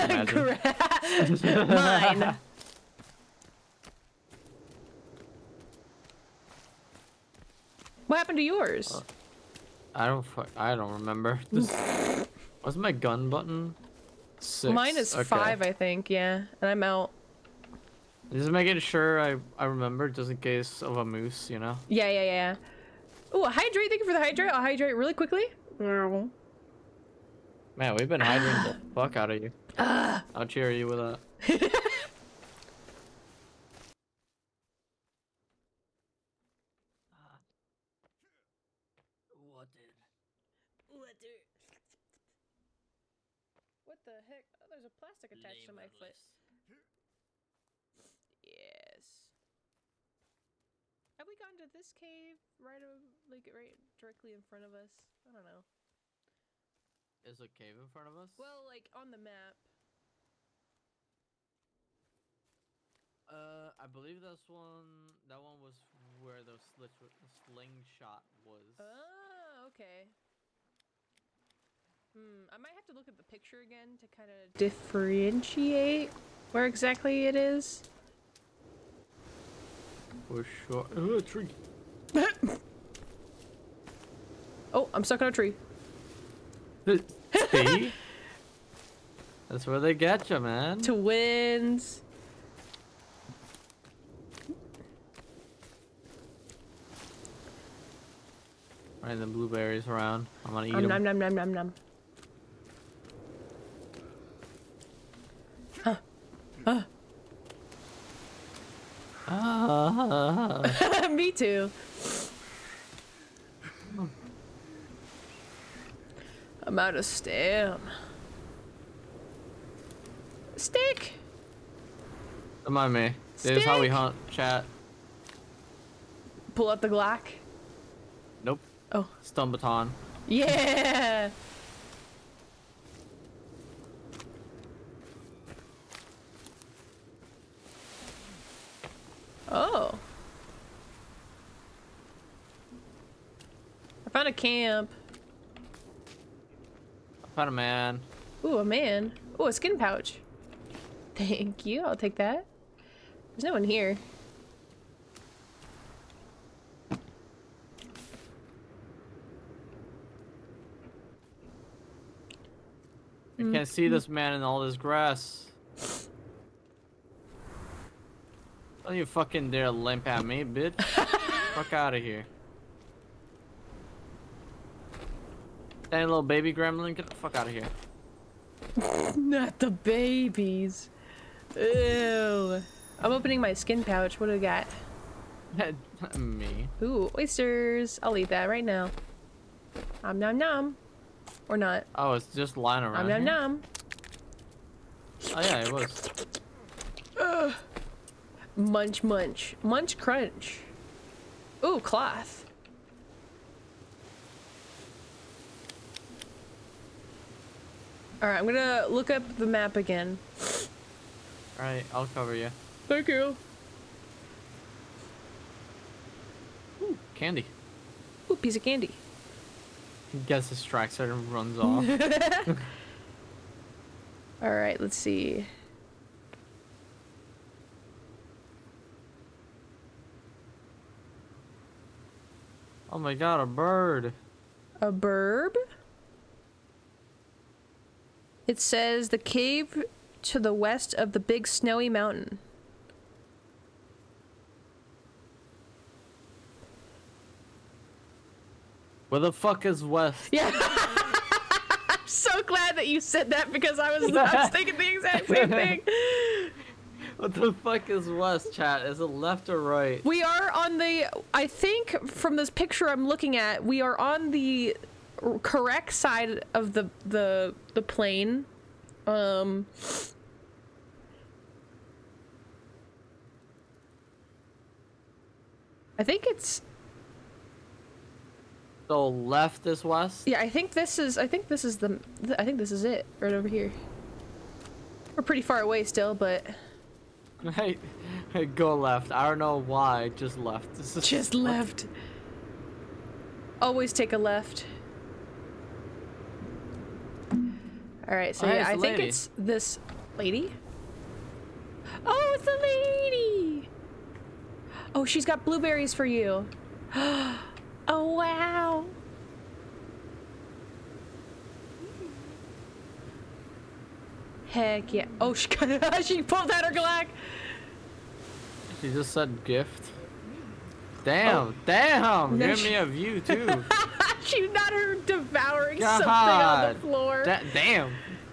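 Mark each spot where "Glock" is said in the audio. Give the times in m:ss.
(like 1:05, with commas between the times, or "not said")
2:06, 5:16.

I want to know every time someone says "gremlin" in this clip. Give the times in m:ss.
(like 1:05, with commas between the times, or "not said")
2:56.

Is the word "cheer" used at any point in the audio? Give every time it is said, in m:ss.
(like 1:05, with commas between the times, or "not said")
0:30.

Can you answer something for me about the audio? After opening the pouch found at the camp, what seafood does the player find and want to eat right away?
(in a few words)
Oysters.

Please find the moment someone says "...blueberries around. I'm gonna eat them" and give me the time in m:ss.
1:39.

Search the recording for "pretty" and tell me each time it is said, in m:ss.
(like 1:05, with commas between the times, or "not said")
4:45.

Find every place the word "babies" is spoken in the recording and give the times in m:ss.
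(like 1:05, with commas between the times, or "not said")
2:59.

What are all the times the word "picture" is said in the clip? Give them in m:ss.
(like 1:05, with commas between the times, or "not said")
1:13, 4:22.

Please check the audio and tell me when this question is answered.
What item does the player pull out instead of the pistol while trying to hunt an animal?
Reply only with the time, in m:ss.
2:09.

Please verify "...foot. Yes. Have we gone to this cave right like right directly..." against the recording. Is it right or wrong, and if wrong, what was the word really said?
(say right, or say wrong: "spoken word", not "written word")
right.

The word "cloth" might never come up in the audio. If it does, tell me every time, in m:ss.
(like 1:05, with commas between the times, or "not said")
3:21.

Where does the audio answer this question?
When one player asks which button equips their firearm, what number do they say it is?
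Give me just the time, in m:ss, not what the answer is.
0:14.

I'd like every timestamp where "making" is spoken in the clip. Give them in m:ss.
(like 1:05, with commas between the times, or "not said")
0:18.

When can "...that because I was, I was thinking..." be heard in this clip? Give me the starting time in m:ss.
4:13.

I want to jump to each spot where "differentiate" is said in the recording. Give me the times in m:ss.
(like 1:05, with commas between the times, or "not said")
1:14.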